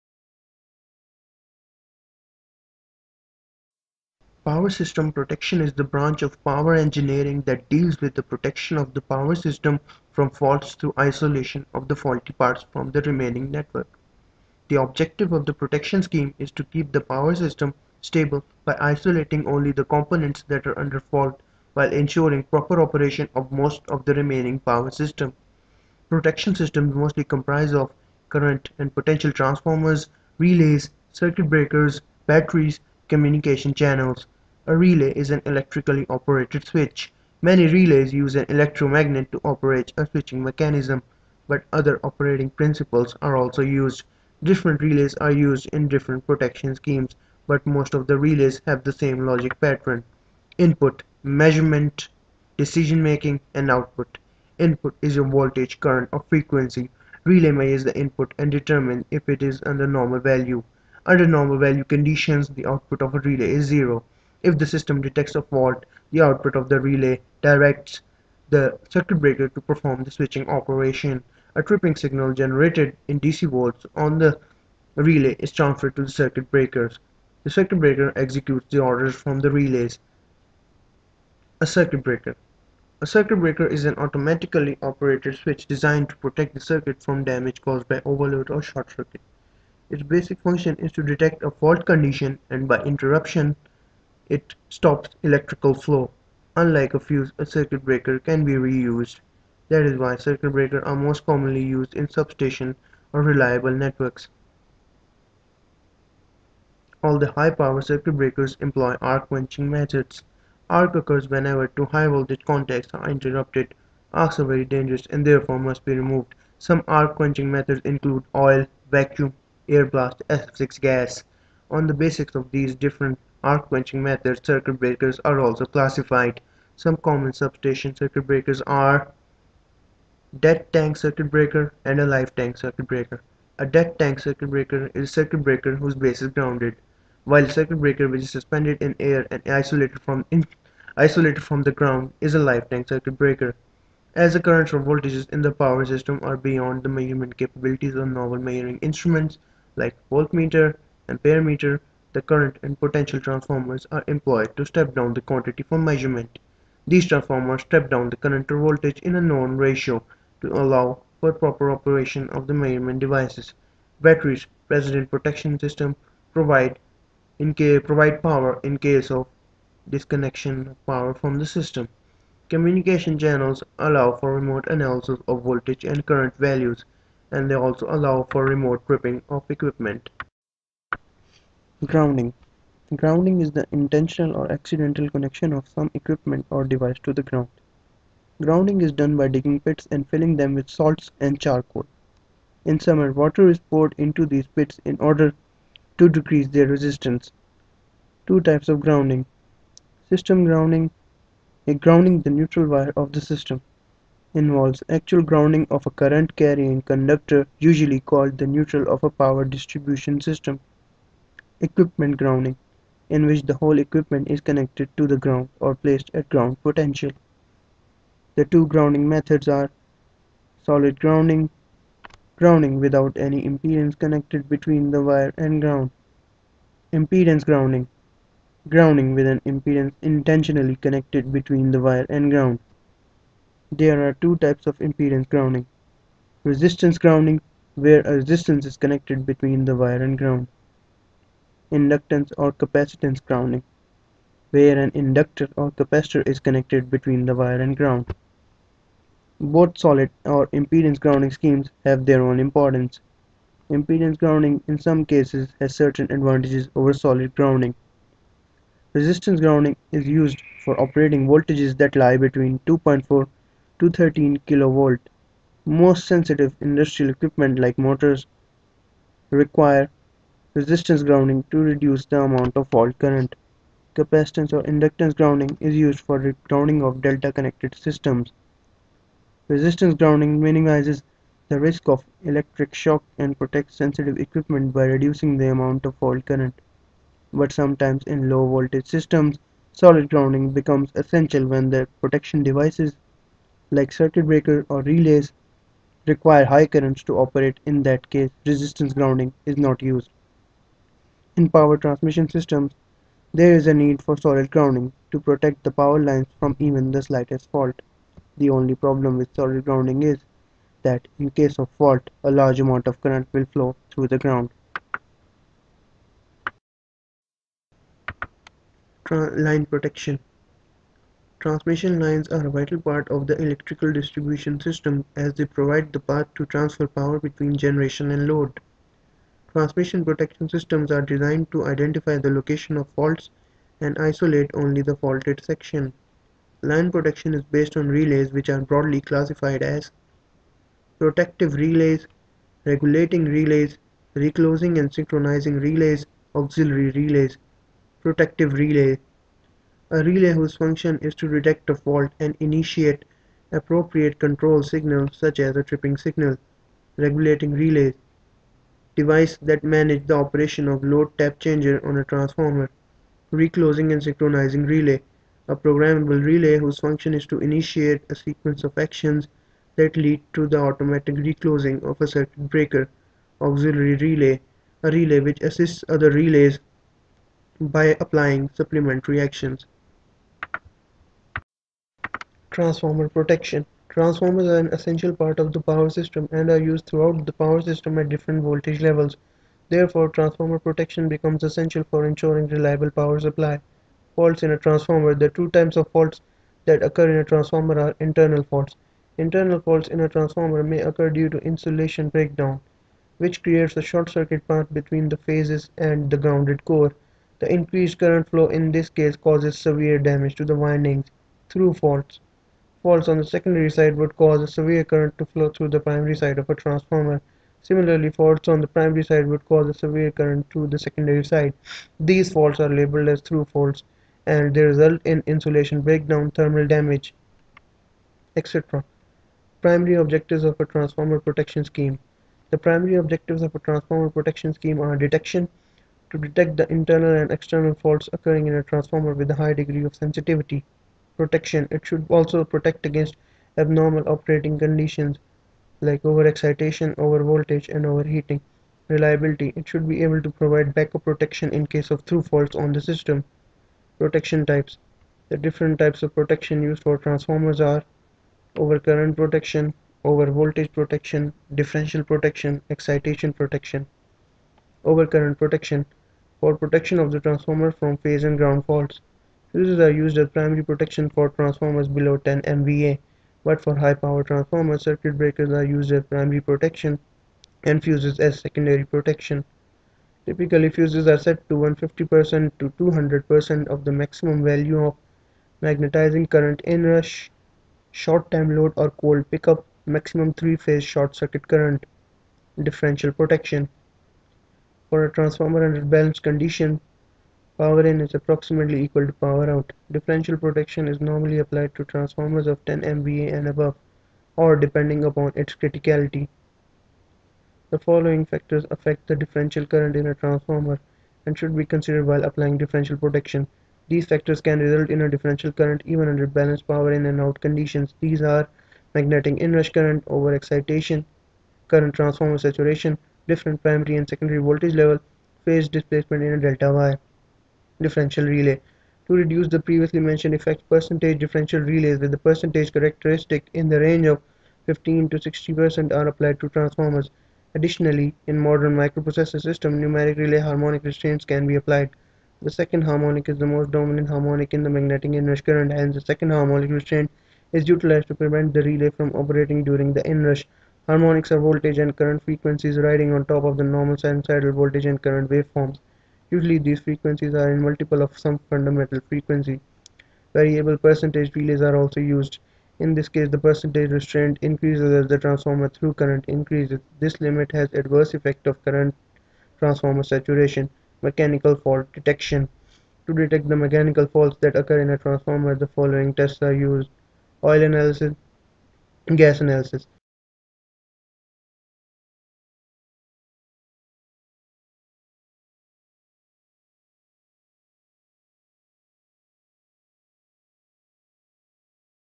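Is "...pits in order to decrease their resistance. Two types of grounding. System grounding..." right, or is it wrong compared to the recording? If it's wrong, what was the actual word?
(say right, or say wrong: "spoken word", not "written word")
right.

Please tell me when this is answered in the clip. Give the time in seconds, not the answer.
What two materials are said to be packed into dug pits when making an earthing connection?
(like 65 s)
190 s.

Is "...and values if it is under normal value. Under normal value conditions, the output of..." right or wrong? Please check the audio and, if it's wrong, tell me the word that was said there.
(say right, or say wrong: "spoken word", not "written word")
wrong: "determines", not "values".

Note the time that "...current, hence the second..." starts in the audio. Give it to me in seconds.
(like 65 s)
545 s.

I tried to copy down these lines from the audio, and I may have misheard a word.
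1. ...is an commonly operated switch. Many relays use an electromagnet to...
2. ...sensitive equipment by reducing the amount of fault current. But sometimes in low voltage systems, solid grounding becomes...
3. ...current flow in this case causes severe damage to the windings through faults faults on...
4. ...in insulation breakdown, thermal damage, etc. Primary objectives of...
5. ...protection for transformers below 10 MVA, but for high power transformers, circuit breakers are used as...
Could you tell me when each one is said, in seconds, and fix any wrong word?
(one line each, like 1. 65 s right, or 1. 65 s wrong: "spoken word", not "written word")
1. 35 s wrong: "electrically", not "commonly"
2. 283 s right
3. 407 s right
4. 425 s right
5. 470 s right.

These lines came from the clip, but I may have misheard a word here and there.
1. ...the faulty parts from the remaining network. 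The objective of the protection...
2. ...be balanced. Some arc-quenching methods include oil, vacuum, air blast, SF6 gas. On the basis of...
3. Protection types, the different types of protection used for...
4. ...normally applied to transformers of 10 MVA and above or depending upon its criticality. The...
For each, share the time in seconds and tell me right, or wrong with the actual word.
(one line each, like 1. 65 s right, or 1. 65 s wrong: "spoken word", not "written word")
1. 11 s right
2. 115 s wrong: "removed", not "balanced"
3. 453 s right
4. 500 s right.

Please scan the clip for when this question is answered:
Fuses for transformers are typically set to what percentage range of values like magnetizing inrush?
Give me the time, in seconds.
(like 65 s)
481 s.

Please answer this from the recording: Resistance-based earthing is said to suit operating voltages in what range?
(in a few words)
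2.4 to 13 kV.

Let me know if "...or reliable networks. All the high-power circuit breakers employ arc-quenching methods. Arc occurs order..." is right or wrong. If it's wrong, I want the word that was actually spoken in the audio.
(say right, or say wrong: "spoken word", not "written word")
wrong: "whenever", not "order".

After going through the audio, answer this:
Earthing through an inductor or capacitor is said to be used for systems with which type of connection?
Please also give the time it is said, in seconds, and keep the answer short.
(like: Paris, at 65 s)
Delta connected, at 277 s.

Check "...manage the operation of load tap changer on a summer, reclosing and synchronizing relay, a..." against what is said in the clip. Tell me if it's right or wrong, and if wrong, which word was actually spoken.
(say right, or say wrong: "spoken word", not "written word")
wrong: "transformer", not "summer".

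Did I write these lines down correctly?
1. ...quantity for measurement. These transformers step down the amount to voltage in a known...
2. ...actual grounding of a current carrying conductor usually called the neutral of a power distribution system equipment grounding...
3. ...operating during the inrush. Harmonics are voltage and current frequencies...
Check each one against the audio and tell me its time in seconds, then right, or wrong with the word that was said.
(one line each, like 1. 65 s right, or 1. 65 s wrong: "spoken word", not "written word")
1. 155 s wrong: "current", not "amount"
2. 204 s right
3. 549 s right.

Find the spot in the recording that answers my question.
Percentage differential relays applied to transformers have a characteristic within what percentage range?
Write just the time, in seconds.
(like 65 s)
534 s.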